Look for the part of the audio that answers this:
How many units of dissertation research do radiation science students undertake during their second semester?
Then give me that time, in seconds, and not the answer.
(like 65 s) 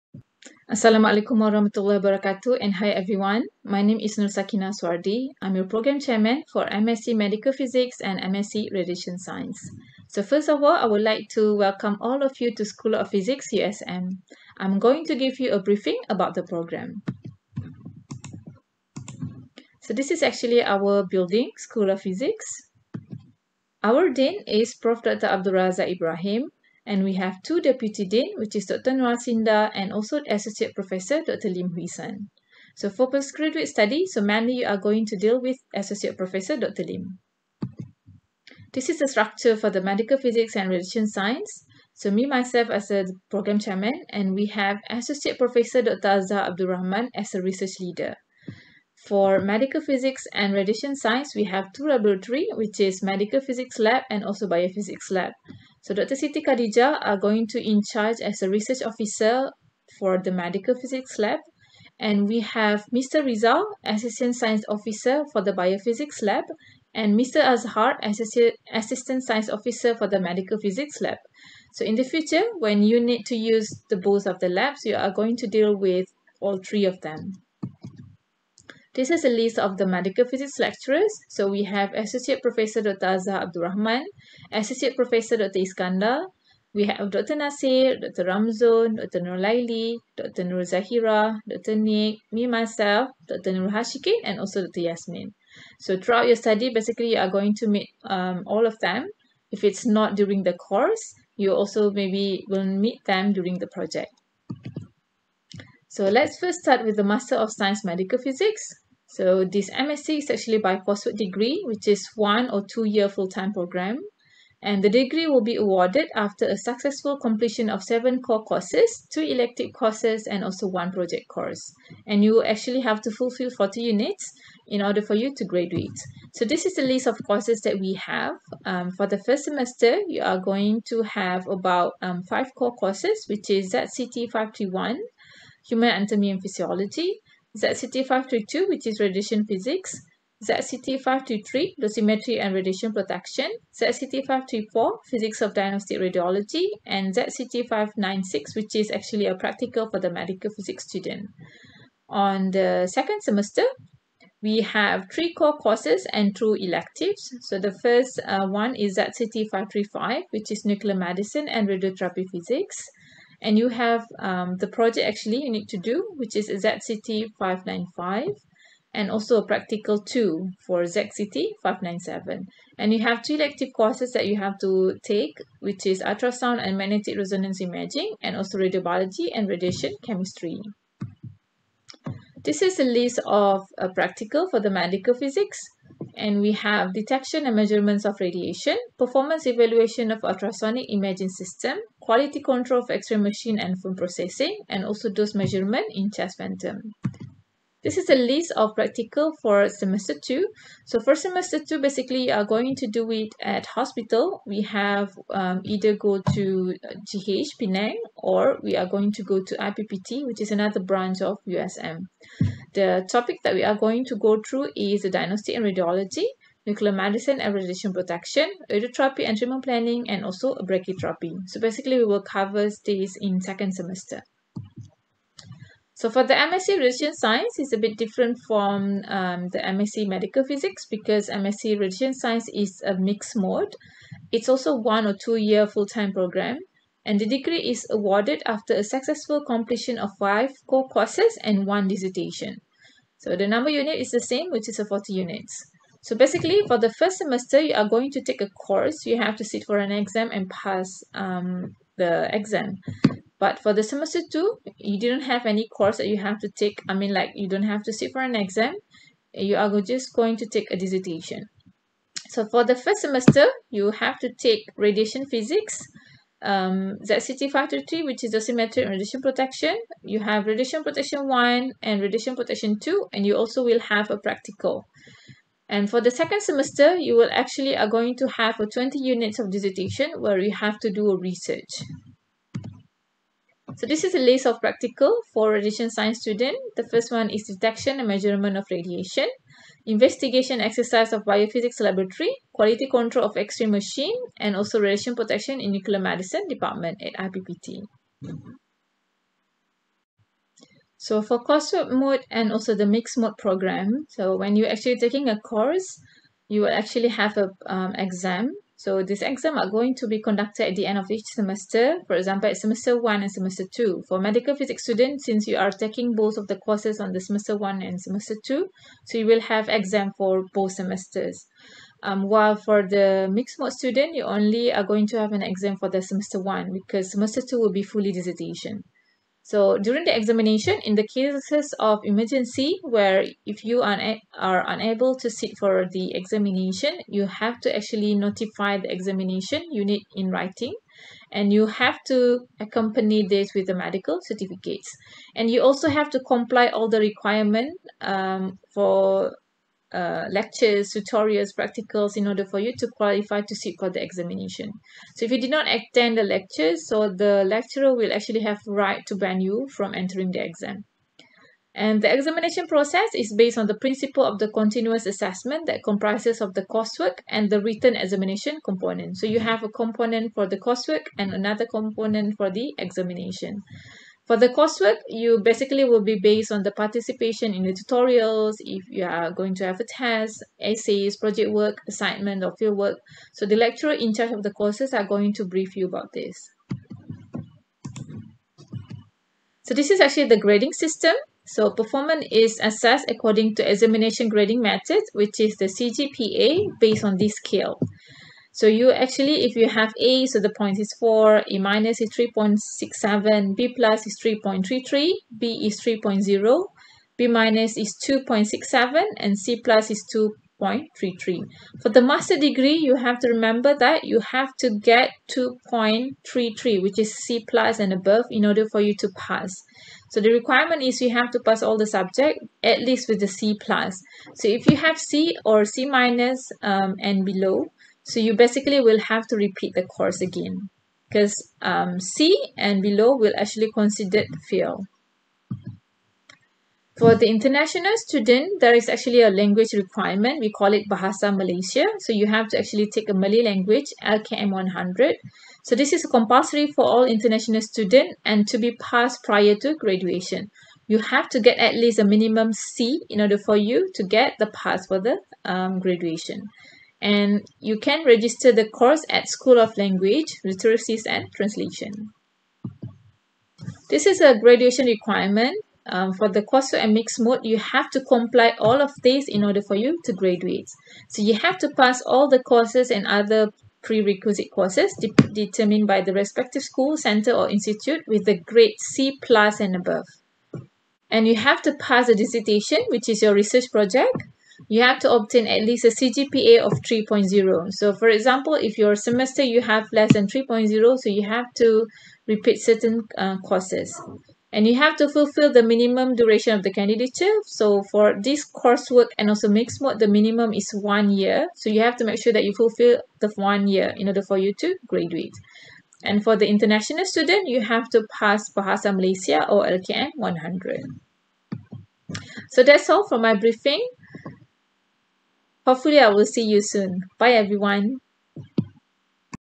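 278 s.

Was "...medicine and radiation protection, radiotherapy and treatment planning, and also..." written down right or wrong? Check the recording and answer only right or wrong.
right.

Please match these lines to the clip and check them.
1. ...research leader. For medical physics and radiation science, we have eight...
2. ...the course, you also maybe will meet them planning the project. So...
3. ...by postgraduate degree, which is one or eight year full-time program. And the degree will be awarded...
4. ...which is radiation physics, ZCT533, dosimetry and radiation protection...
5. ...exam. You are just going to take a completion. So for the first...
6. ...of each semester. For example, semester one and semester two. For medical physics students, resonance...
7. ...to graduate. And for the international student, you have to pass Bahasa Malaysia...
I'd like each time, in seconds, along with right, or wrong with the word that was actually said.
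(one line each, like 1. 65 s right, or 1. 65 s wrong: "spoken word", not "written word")
1. 47 s wrong: "two", not "eight"
2. 100 s wrong: "during", not "planning"
3. 110 s wrong: "two", not "eight"
4. 138 s right
5. 258 s wrong: "dissertation", not "completion"
6. 310 s wrong: "since", not "resonance"
7. 504 s right.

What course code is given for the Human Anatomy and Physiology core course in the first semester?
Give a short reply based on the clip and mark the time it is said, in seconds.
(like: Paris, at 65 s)
ZCT 531, at 133 s.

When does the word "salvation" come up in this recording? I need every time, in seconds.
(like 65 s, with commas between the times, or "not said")
not said.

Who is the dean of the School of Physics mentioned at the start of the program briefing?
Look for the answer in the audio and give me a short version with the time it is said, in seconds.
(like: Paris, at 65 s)
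Prof. Dr. Abdul Razak Ibrahim, at 24 s.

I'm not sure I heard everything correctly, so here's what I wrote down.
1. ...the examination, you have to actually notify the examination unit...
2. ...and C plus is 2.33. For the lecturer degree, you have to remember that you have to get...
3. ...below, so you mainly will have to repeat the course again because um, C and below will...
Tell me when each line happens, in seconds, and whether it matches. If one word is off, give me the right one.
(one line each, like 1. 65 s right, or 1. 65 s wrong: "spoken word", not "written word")
1. 335 s right
2. 409 s wrong: "master", not "lecturer"
3. 427 s wrong: "basically", not "mainly".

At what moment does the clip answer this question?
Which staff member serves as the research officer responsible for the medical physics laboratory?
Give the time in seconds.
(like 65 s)
55 s.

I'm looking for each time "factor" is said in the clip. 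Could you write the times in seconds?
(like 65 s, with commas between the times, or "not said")
267 s.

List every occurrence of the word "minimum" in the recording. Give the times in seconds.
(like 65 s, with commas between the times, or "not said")
452 s, 495 s, 500 s.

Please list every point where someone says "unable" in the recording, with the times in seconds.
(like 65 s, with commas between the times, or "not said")
334 s.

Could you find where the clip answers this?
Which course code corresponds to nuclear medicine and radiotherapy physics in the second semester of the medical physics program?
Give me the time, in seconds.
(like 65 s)
158 s.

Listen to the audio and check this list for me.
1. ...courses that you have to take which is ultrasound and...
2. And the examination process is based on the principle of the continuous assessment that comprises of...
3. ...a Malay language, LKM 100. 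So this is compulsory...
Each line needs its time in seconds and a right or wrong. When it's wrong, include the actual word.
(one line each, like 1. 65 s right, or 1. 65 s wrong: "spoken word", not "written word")
1. 173 s right
2. 361 s right
3. 443 s right.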